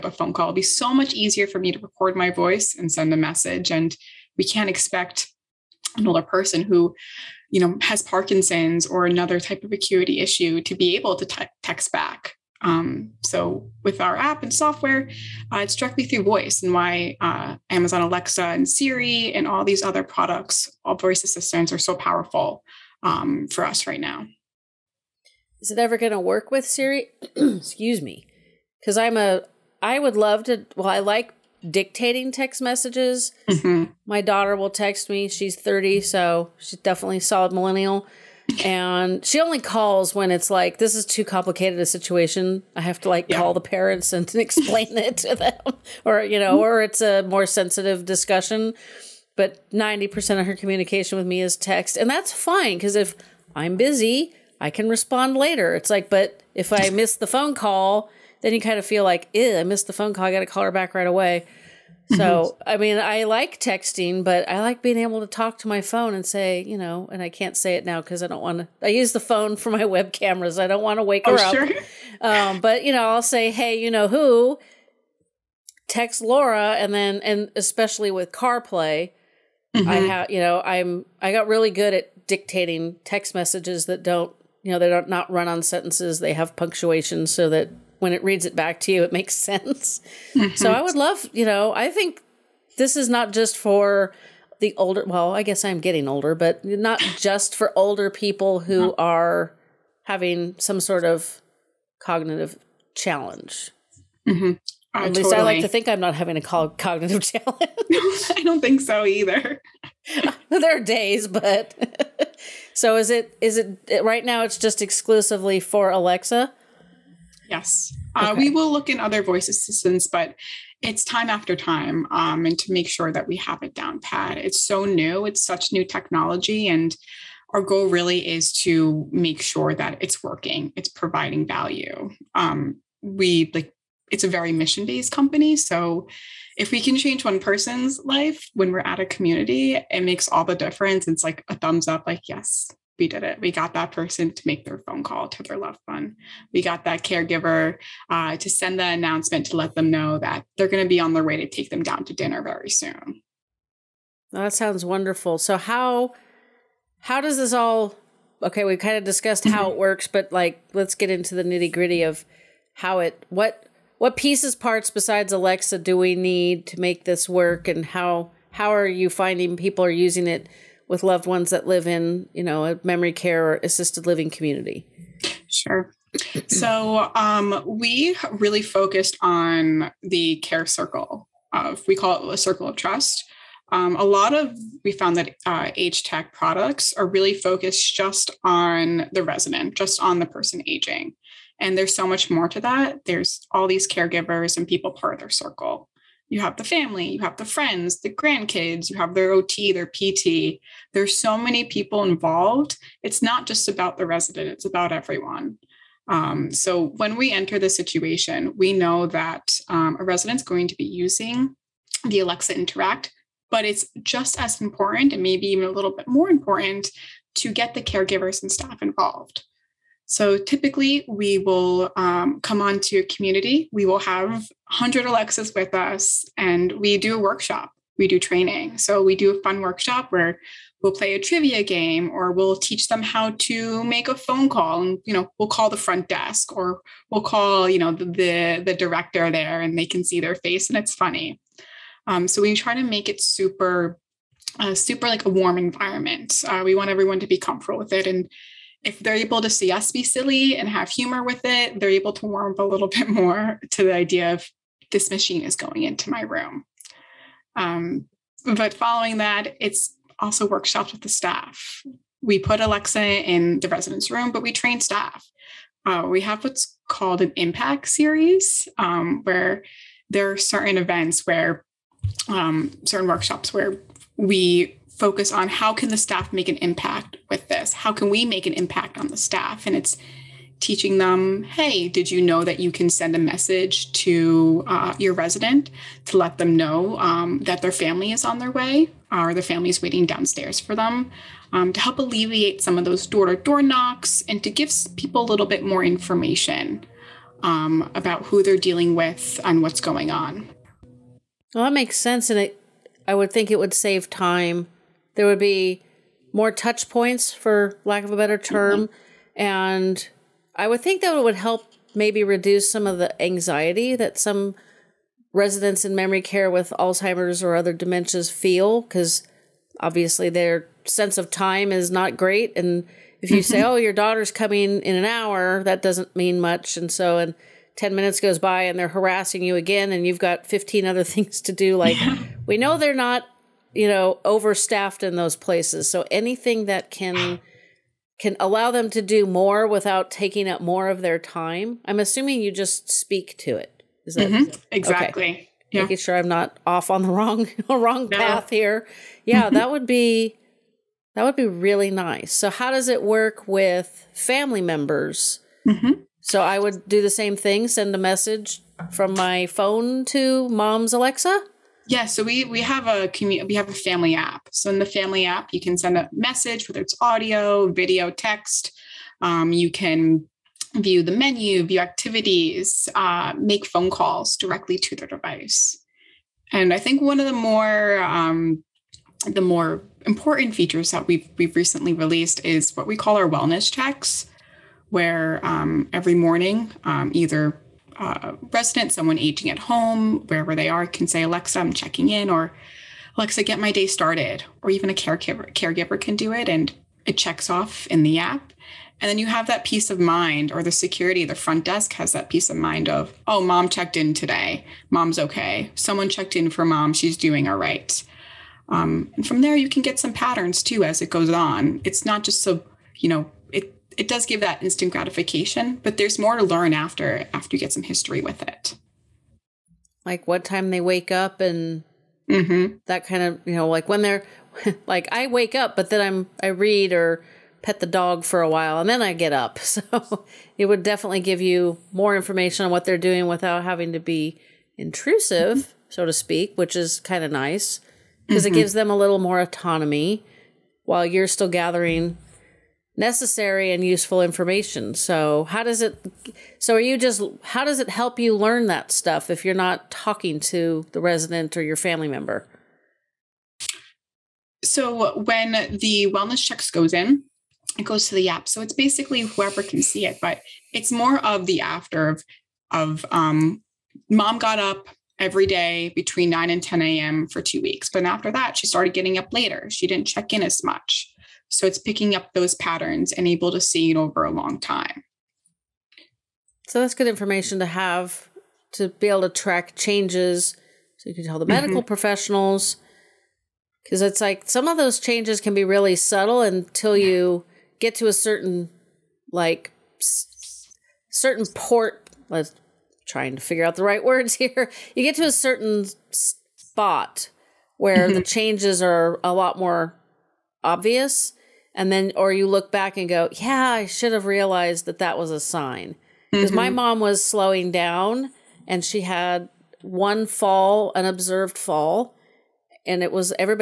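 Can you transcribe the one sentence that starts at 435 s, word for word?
so to speak, which is kind of nice because mm-hmm.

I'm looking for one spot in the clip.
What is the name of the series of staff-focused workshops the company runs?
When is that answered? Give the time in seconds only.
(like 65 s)
267 s.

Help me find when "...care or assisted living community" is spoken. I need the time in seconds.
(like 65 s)
173 s.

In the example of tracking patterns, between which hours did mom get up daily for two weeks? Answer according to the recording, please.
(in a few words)
9 and 10 a.m.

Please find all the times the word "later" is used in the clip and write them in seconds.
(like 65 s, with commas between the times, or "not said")
55 s, 469 s.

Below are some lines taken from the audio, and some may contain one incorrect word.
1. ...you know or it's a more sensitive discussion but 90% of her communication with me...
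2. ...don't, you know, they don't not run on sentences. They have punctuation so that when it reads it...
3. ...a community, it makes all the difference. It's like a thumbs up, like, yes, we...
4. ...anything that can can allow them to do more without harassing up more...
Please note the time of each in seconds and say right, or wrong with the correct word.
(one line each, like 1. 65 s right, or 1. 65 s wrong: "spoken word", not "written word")
1. 46 s right
2. 84 s right
3. 138 s right
4. 336 s wrong: "taking", not "harassing".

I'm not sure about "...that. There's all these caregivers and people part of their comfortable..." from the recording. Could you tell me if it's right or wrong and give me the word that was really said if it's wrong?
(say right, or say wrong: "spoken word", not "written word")
wrong: "circle", not "comfortable".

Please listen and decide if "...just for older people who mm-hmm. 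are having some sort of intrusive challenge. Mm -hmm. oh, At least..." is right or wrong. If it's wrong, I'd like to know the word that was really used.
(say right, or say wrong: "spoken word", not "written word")
wrong: "cognitive", not "intrusive".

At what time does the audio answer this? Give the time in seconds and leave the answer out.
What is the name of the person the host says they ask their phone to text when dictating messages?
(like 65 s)
76 s.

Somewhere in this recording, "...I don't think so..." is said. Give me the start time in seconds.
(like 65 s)
108 s.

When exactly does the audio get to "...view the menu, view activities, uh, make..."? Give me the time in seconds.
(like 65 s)
370 s.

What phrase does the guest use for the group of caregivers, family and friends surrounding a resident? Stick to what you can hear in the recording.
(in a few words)
circle of trust.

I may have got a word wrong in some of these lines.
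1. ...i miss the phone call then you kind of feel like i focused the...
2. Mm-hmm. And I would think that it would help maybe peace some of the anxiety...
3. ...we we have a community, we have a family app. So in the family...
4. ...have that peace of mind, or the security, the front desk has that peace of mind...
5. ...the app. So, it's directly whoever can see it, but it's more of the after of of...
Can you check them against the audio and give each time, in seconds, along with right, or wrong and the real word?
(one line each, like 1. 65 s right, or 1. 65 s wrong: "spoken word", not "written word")
1. 56 s wrong: "missed", not "focused"
2. 308 s wrong: "reduce", not "peace"
3. 362 s right
4. 399 s right
5. 458 s wrong: "basically", not "directly".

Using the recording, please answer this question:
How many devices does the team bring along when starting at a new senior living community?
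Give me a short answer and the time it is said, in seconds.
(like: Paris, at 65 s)
100, at 224 s.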